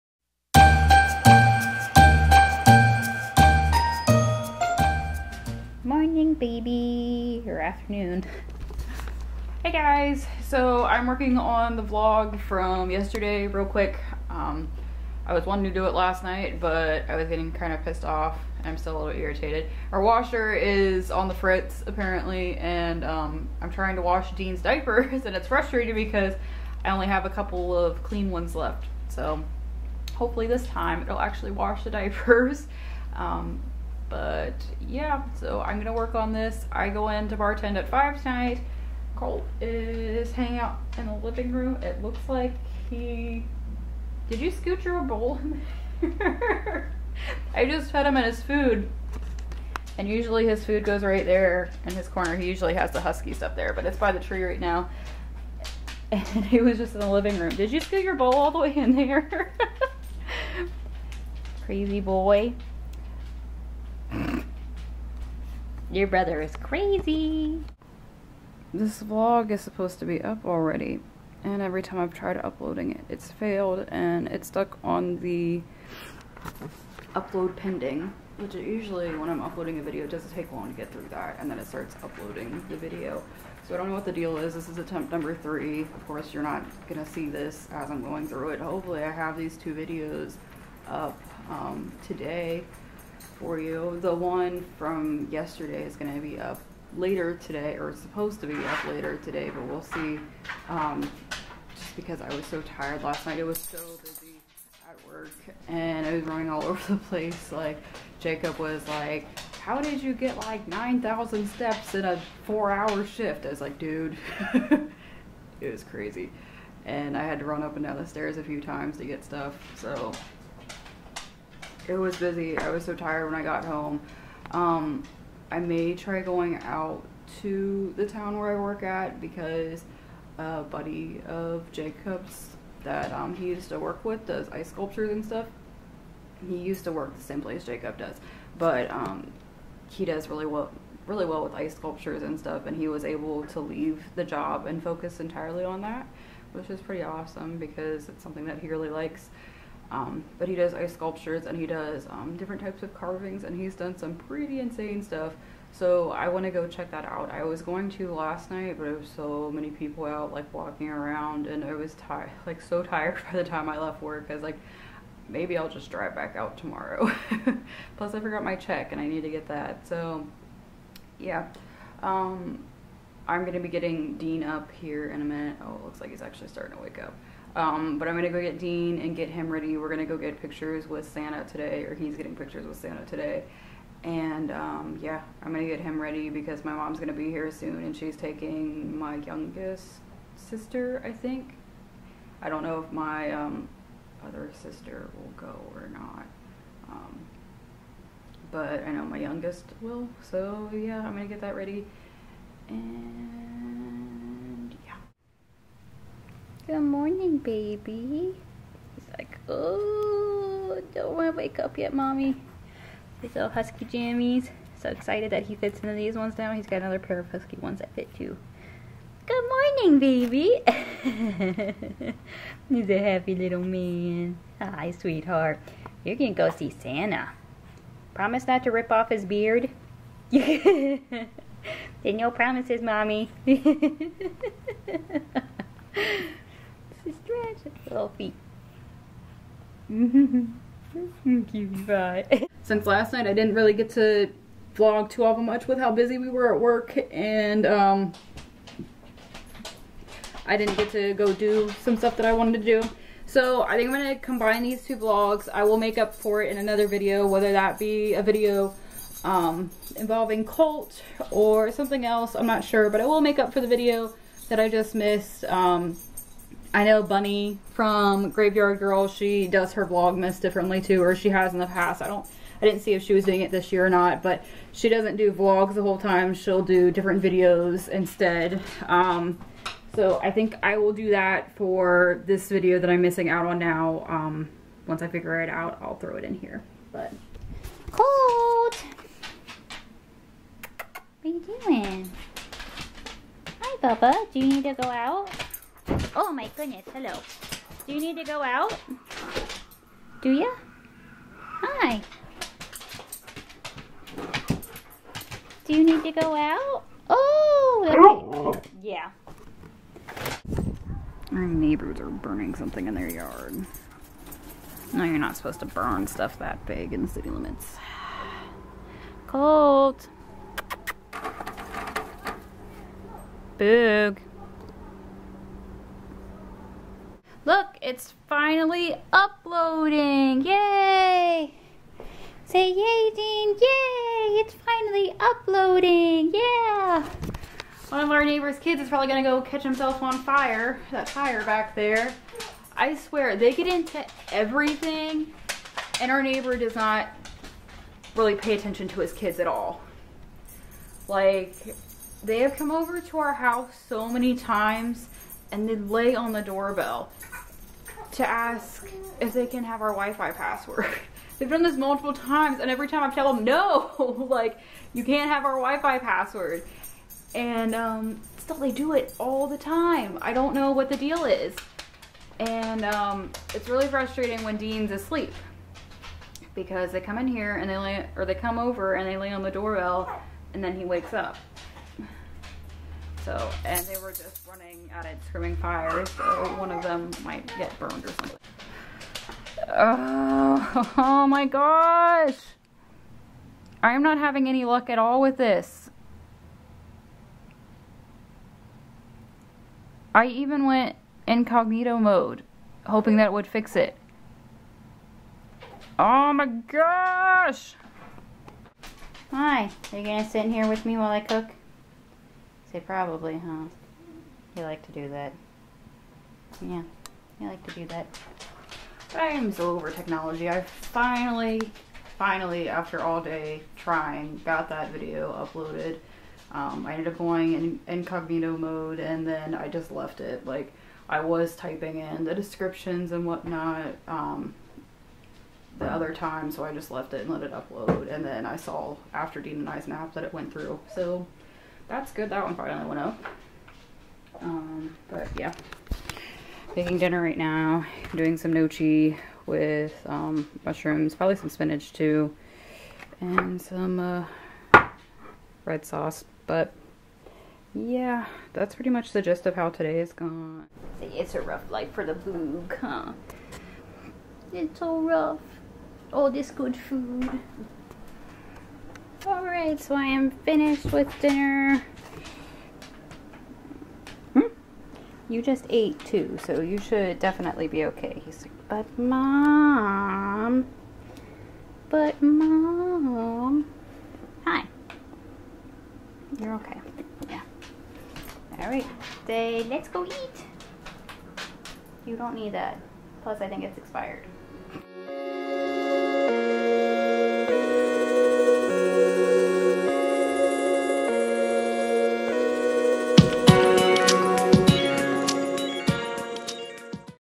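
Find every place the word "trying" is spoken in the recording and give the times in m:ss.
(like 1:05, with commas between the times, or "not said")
0:23, 7:03.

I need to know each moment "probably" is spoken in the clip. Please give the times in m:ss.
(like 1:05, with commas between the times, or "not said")
5:38, 6:52, 7:31.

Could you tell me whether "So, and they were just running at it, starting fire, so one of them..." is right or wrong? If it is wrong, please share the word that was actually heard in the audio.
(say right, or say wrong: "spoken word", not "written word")
wrong: "screaming", not "starting".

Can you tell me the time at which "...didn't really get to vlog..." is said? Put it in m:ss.
4:03.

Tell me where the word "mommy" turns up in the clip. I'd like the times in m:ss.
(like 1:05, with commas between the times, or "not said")
3:31, 3:52.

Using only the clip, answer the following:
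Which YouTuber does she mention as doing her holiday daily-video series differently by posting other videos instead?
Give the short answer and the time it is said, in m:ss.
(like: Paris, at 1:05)
Bunny from Graveyard Girl, at 4:27.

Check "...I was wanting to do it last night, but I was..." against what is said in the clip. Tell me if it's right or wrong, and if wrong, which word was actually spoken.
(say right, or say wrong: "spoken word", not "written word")
right.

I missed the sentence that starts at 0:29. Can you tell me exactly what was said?
So hopefully this time it'll actually wash the diapers.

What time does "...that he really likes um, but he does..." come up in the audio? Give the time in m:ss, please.
2:28.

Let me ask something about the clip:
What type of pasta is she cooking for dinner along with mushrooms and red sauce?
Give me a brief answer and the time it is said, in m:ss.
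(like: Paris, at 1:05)
gnocchi, at 7:28.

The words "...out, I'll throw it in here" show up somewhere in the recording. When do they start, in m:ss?
4:45.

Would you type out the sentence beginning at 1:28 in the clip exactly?
Hopefully I have these two videos up um, today for you.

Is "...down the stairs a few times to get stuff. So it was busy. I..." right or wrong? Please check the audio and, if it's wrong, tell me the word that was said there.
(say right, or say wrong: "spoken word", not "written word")
right.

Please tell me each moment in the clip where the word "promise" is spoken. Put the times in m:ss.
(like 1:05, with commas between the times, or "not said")
3:48, 3:52.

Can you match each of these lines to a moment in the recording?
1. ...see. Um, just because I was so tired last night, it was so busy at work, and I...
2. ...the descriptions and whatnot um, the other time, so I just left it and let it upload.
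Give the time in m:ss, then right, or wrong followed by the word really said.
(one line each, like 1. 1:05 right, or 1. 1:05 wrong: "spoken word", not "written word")
1. 1:39 right
2. 7:12 right.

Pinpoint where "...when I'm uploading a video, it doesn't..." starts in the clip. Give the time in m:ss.
1:19.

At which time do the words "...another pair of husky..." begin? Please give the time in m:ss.
3:36.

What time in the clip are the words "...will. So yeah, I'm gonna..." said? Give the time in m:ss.
3:19.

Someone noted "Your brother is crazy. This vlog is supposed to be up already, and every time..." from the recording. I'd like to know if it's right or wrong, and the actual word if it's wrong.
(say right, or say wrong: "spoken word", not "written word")
right.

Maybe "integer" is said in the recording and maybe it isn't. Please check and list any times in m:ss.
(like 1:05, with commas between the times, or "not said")
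not said.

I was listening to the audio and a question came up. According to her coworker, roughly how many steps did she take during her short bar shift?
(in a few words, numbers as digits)
9,000.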